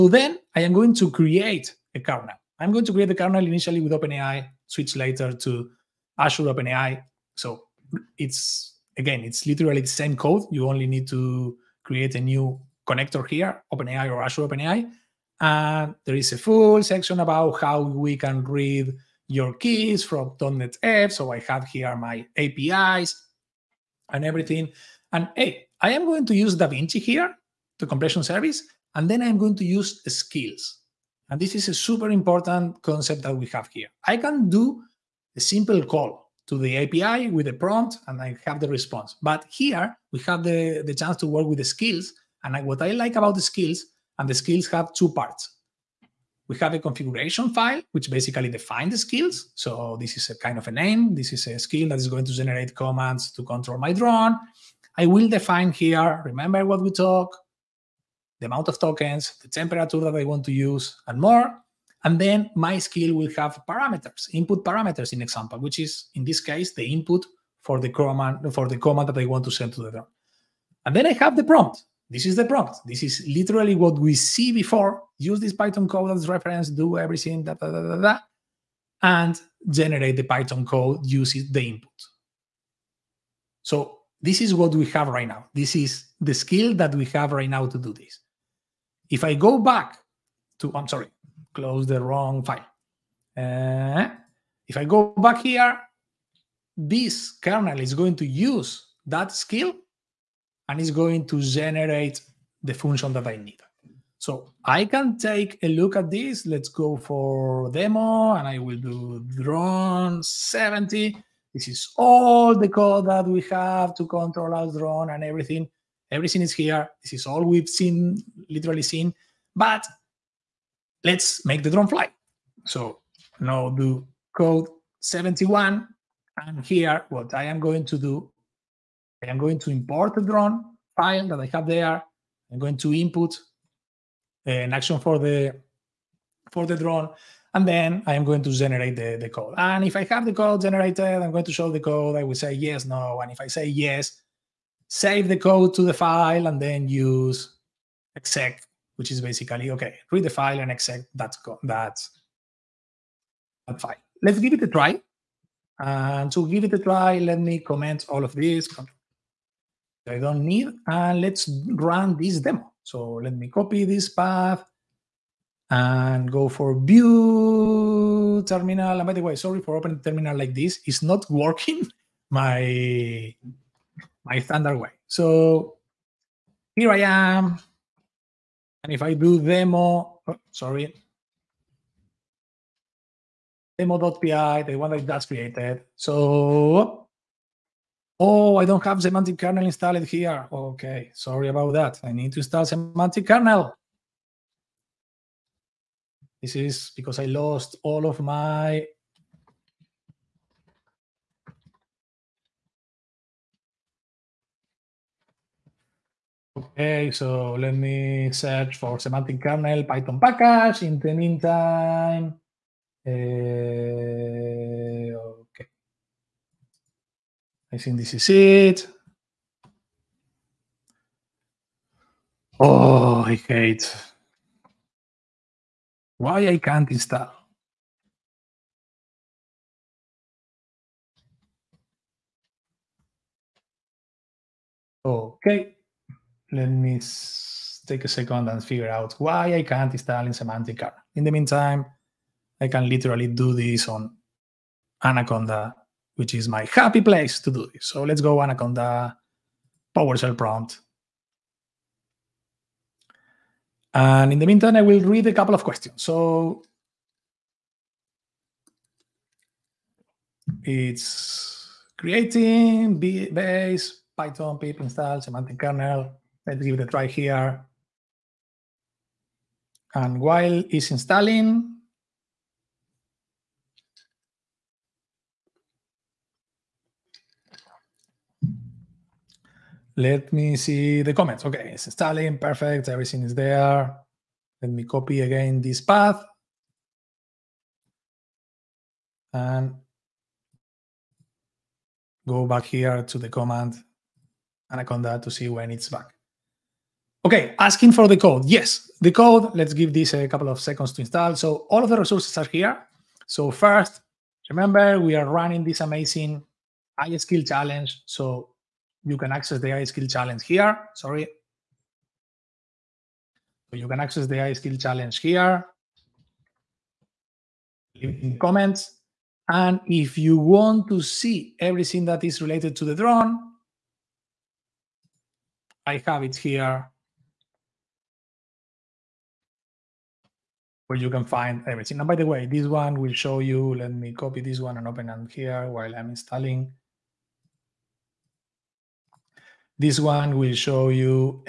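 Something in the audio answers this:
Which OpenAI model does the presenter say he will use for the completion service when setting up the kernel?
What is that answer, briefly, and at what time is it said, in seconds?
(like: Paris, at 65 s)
DaVinci, at 26 s.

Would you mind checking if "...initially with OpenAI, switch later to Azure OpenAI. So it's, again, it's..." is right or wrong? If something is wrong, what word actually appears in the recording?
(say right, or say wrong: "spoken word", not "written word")
right.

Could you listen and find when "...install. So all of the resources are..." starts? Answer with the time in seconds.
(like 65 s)
301 s.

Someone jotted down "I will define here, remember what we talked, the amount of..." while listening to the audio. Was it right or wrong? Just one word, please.
right.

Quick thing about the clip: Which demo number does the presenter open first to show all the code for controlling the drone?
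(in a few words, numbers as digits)
70.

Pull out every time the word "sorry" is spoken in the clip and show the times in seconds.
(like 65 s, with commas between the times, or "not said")
90 s, 169 s, 180 s, 191 s, 310 s.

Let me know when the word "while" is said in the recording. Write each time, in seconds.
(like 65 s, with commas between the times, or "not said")
270 s, 335 s.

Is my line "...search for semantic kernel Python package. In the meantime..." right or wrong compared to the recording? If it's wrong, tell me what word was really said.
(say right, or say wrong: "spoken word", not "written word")
right.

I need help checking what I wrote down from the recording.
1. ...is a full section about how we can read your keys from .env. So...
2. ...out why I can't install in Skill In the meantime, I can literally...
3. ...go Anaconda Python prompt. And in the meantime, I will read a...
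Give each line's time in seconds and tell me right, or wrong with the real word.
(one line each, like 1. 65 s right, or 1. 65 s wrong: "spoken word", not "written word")
1. 16 s right
2. 238 s wrong: "Semantic", not "Skill"
3. 248 s wrong: "PowerShell", not "Python".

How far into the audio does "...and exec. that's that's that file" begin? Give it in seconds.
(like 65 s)
150 s.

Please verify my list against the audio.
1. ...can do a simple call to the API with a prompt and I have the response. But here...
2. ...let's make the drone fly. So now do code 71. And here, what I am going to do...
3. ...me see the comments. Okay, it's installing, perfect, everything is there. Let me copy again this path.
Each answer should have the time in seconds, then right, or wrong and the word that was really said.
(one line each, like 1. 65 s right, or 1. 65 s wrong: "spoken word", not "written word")
1. 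34 s right
2. 121 s right
3. 280 s right.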